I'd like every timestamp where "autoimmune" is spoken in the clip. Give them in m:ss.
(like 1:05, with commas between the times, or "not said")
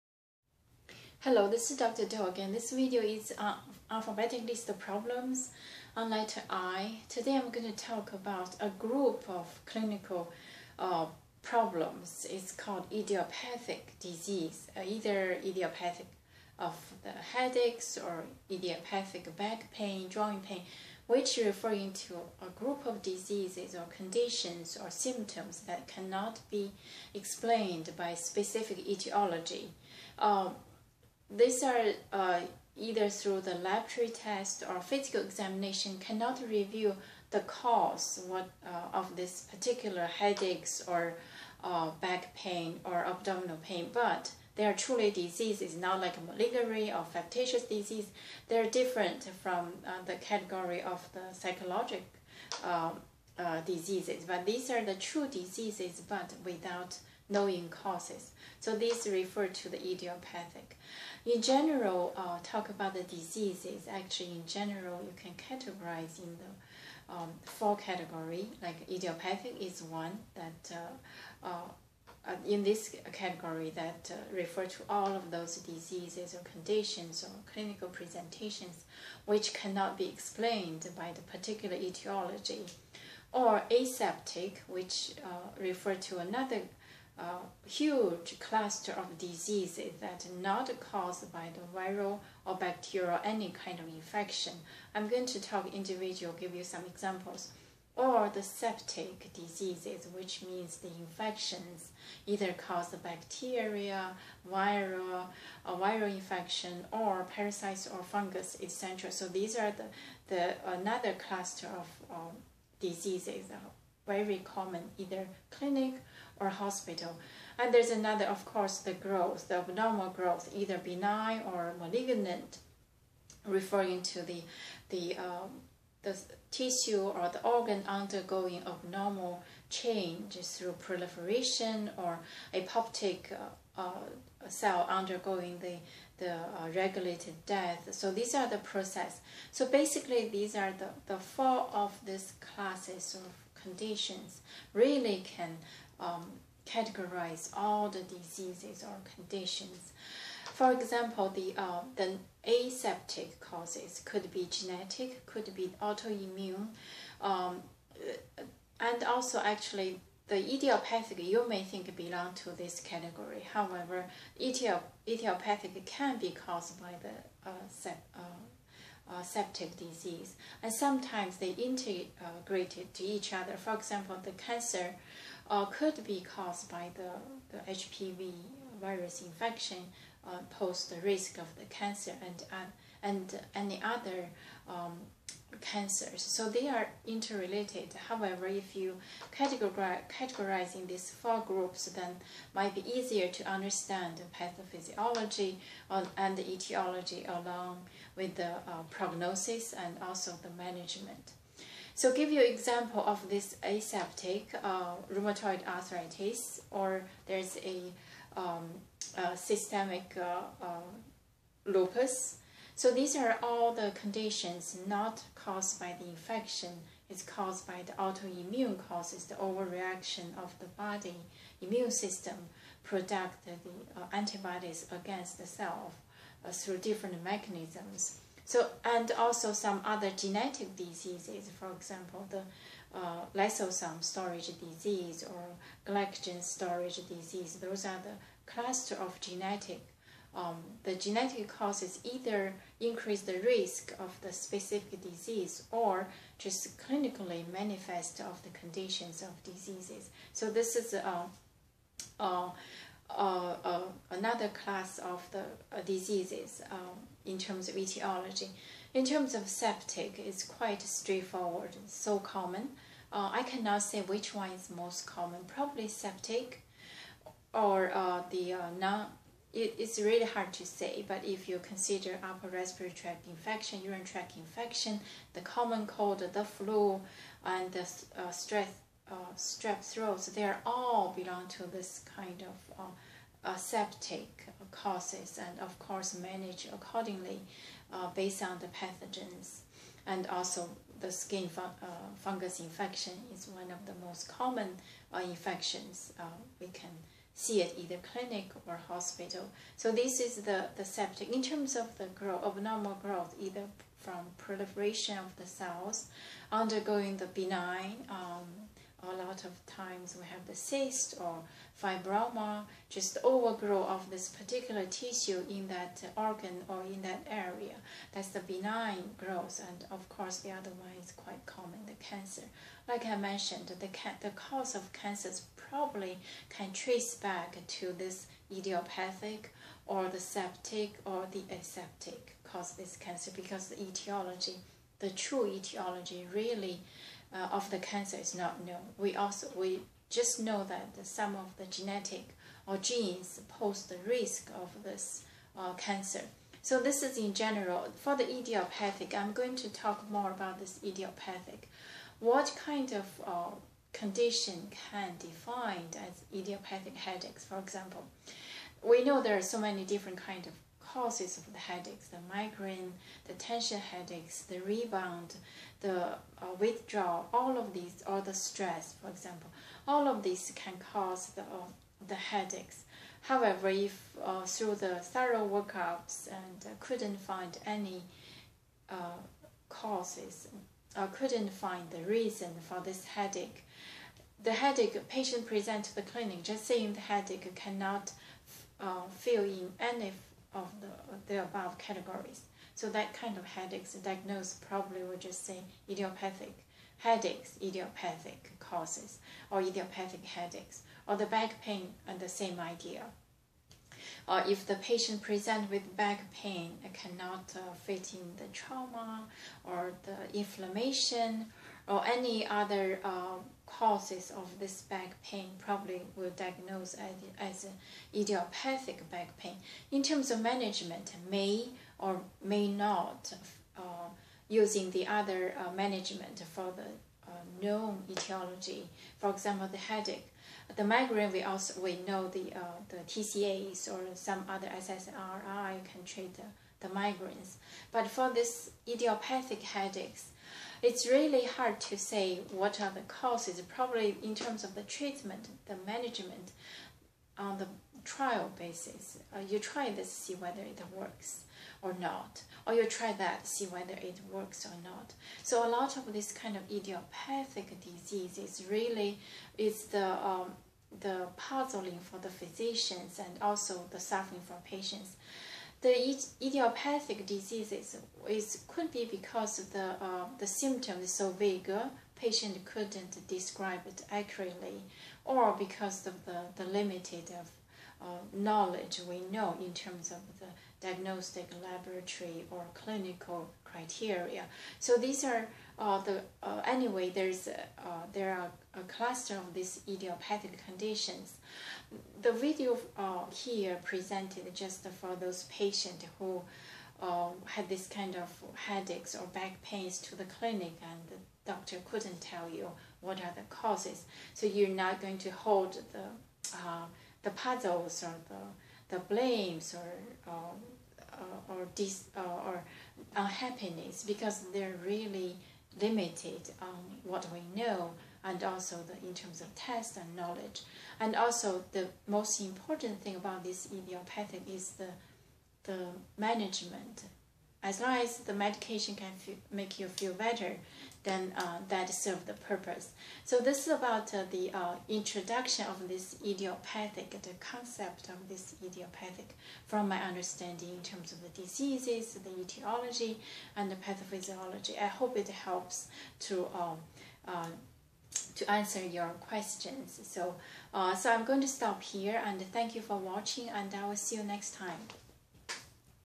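2:35, 3:37.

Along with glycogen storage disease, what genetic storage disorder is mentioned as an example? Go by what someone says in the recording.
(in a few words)
lysosome storage disease.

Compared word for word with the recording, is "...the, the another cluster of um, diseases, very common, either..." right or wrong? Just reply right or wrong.
right.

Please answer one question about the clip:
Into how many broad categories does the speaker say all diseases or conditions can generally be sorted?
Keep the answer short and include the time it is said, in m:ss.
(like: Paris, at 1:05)
4, at 1:07.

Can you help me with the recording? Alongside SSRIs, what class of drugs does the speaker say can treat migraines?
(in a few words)
TCAs.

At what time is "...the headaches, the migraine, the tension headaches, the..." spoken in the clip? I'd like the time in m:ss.
6:01.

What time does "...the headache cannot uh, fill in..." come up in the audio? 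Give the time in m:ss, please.
6:26.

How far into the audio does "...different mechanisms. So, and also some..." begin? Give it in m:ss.
3:46.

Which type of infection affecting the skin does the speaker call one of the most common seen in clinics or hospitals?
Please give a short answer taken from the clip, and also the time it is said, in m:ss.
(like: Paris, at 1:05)
fungus infection, at 4:52.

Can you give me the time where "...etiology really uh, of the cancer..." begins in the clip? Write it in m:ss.
5:35.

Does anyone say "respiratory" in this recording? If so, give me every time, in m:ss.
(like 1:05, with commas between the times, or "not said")
4:32.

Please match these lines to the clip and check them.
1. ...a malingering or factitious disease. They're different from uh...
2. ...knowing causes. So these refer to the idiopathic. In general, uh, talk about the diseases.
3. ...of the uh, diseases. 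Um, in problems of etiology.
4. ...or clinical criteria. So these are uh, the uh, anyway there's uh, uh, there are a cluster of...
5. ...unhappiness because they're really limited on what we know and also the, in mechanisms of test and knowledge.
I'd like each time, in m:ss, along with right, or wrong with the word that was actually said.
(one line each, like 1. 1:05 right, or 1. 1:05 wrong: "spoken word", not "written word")
1. 0:46 right
2. 0:57 right
3. 4:14 wrong: "terms", not "problems"
4. 8:02 right
5. 8:33 wrong: "terms", not "mechanisms".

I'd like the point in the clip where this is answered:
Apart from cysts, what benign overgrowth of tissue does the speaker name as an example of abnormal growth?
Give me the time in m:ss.
5:11.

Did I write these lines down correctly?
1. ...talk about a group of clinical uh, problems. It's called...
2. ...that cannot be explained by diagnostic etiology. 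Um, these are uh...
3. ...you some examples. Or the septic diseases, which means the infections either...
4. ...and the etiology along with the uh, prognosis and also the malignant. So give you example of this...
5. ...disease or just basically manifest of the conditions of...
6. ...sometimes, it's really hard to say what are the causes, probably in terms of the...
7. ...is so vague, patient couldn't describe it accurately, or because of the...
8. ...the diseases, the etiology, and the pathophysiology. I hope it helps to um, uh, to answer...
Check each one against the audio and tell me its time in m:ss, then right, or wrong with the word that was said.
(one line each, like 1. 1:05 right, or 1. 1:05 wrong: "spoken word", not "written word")
1. 0:07 right
2. 0:25 wrong: "specific", not "diagnostic"
3. 1:36 right
4. 3:16 wrong: "management", not "malignant"
5. 4:05 wrong: "clinically", not "basically"
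6. 7:19 wrong: "headaches", not "sometimes"
7. 7:51 right
8. 9:01 right.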